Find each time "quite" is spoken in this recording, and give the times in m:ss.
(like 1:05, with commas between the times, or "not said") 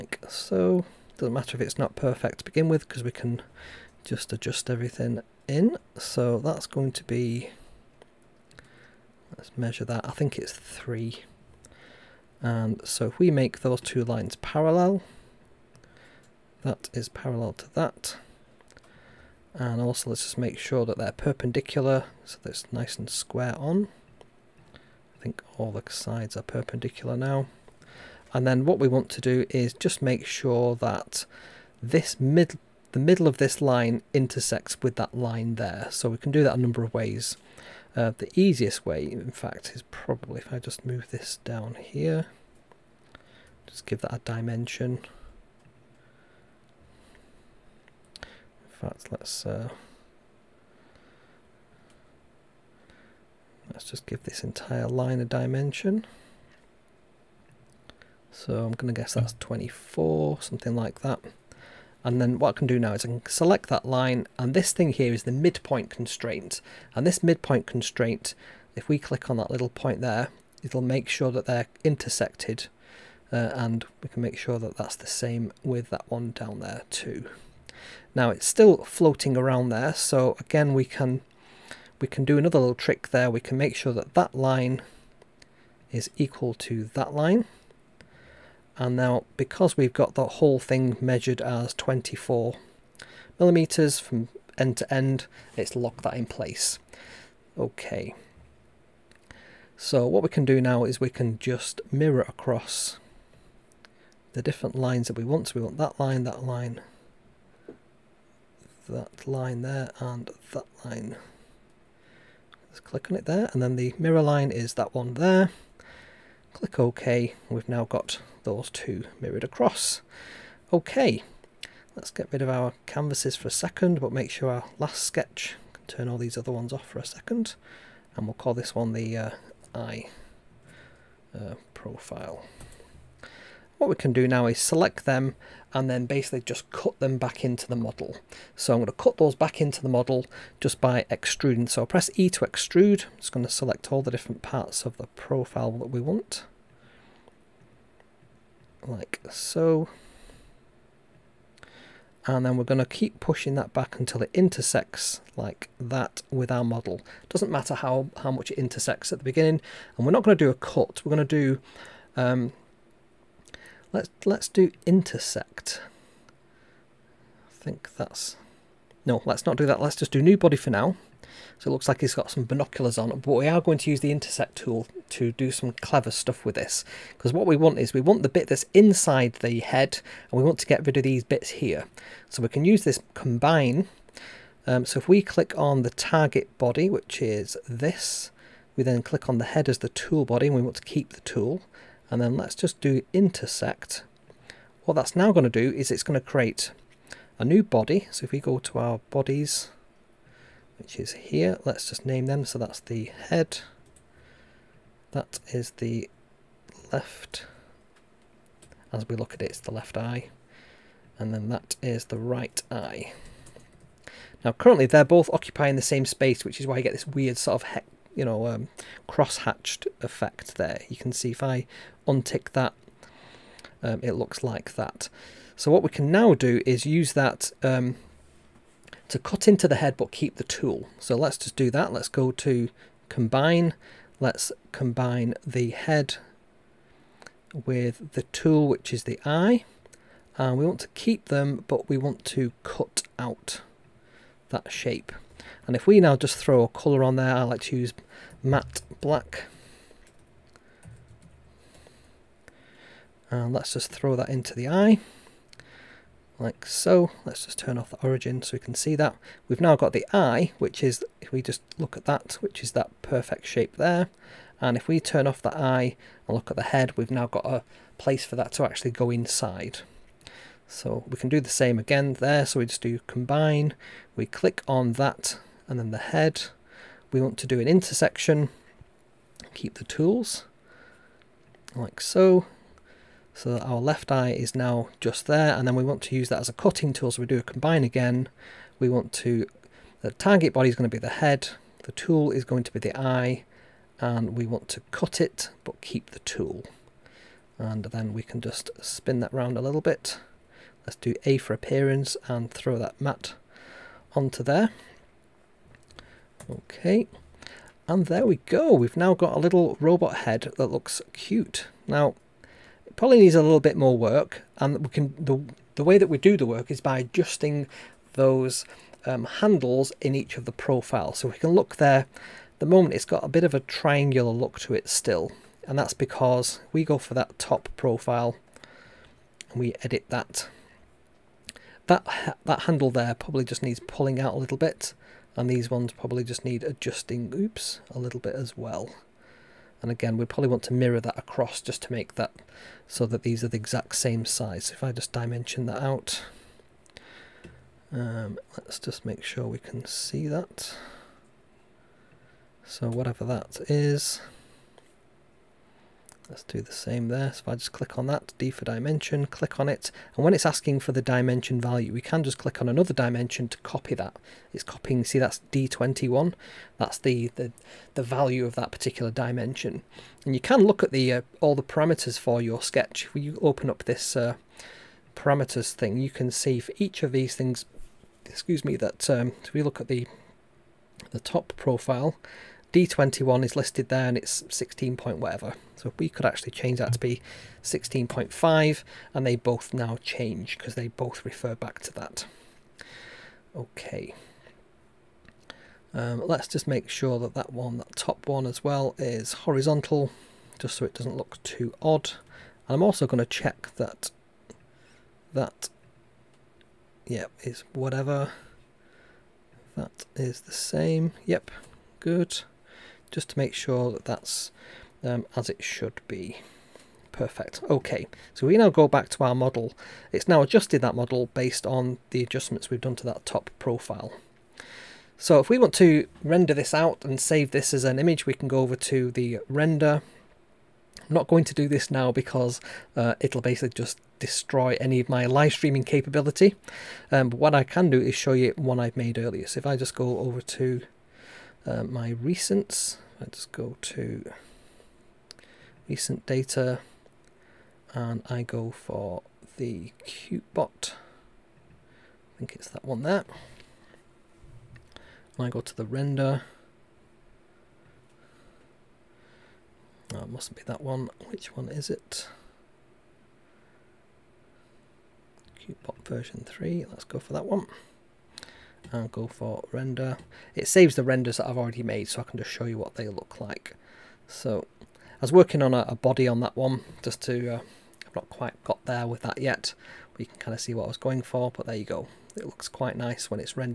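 7:58, 8:02.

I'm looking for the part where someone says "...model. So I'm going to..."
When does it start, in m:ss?
2:17.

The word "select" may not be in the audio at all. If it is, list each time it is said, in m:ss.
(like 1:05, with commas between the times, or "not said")
1:03, 2:14, 2:23.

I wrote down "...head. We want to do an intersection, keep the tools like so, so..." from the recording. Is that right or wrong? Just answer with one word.
right.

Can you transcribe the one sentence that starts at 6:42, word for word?
And I'm also going to check that that, yep, is whatever.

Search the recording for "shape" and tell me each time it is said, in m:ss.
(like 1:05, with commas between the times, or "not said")
4:04, 4:23.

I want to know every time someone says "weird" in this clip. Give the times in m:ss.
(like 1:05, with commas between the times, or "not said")
3:37.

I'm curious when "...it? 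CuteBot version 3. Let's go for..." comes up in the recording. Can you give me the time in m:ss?
7:41.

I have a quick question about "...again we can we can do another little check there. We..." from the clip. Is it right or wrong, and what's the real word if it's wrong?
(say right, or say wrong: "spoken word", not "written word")
wrong: "trick", not "check".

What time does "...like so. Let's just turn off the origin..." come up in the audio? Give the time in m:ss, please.
4:16.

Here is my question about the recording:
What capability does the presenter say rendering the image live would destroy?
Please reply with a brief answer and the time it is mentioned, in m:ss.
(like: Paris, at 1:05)
live streaming, at 7:15.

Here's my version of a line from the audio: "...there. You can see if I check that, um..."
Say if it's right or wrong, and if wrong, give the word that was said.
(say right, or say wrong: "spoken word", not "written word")
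wrong: "untick", not "check".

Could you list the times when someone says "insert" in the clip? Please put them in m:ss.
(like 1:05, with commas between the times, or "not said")
not said.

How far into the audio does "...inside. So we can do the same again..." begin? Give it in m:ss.
4:29.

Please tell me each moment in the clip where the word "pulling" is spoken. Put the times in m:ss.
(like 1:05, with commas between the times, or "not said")
5:33.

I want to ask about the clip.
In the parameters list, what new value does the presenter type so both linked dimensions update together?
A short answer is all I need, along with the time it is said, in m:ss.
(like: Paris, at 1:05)
16.5, at 6:27.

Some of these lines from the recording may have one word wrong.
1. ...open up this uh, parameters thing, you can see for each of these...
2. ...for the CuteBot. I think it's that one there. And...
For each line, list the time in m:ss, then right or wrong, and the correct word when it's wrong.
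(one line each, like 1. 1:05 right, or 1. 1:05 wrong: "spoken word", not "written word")
1. 6:13 right
2. 7:28 right.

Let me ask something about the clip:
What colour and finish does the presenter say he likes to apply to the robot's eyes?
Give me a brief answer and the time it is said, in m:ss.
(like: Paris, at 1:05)
matte black, at 4:08.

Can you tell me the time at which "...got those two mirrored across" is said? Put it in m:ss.
1:57.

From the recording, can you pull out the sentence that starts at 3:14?
What that's now going to do is it's going to create a new body.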